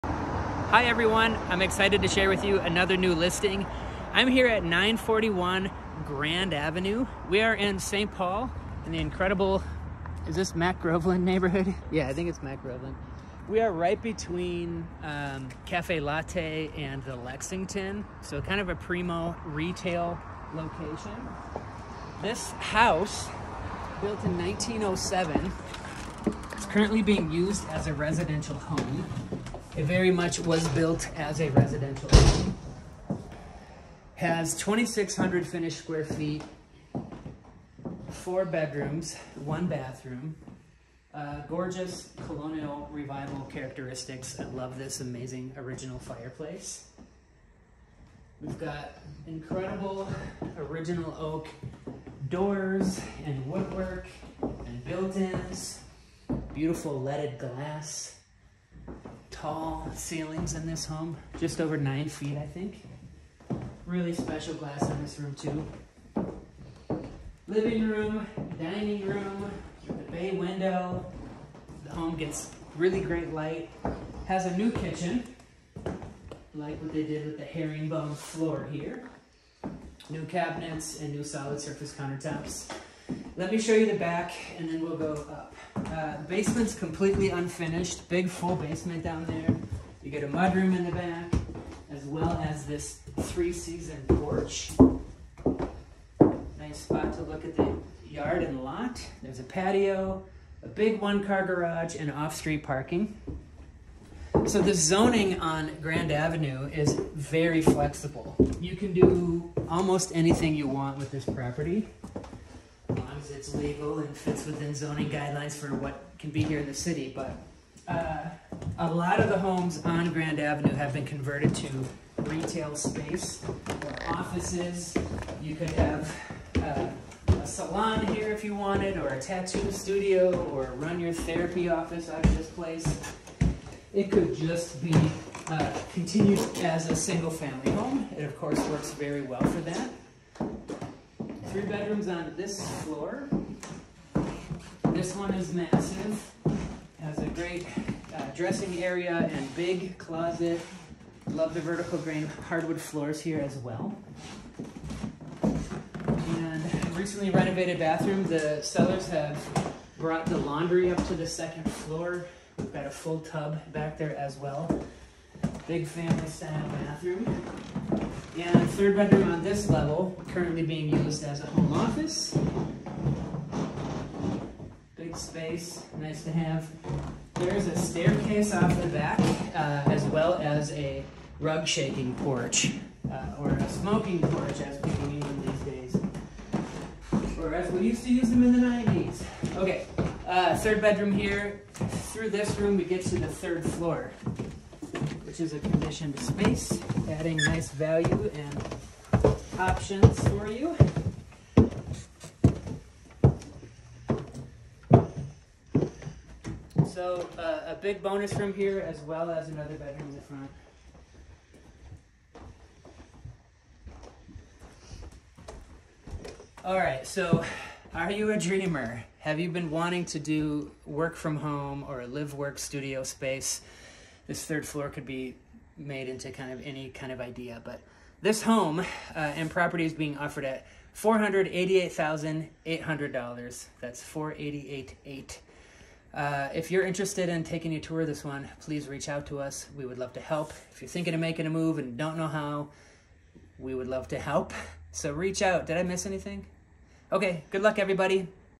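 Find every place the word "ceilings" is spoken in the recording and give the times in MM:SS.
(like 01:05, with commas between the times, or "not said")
00:59.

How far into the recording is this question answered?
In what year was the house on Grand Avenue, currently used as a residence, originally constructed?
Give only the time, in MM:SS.
00:24.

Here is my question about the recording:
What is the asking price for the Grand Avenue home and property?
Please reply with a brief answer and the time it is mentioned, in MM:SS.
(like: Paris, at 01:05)
$488,800, at 03:50.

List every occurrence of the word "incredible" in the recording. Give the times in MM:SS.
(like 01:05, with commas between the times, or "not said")
00:08, 00:49.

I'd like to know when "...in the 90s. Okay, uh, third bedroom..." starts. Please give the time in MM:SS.
03:08.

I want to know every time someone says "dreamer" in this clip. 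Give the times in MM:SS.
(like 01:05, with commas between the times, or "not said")
03:38.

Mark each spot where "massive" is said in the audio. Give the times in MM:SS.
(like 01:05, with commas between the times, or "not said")
02:25.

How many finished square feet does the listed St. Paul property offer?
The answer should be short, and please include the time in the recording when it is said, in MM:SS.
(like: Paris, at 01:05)
2,600, at 00:34.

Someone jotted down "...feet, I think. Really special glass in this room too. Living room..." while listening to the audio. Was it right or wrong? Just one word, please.
right.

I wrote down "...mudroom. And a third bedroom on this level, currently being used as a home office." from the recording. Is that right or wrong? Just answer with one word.
wrong.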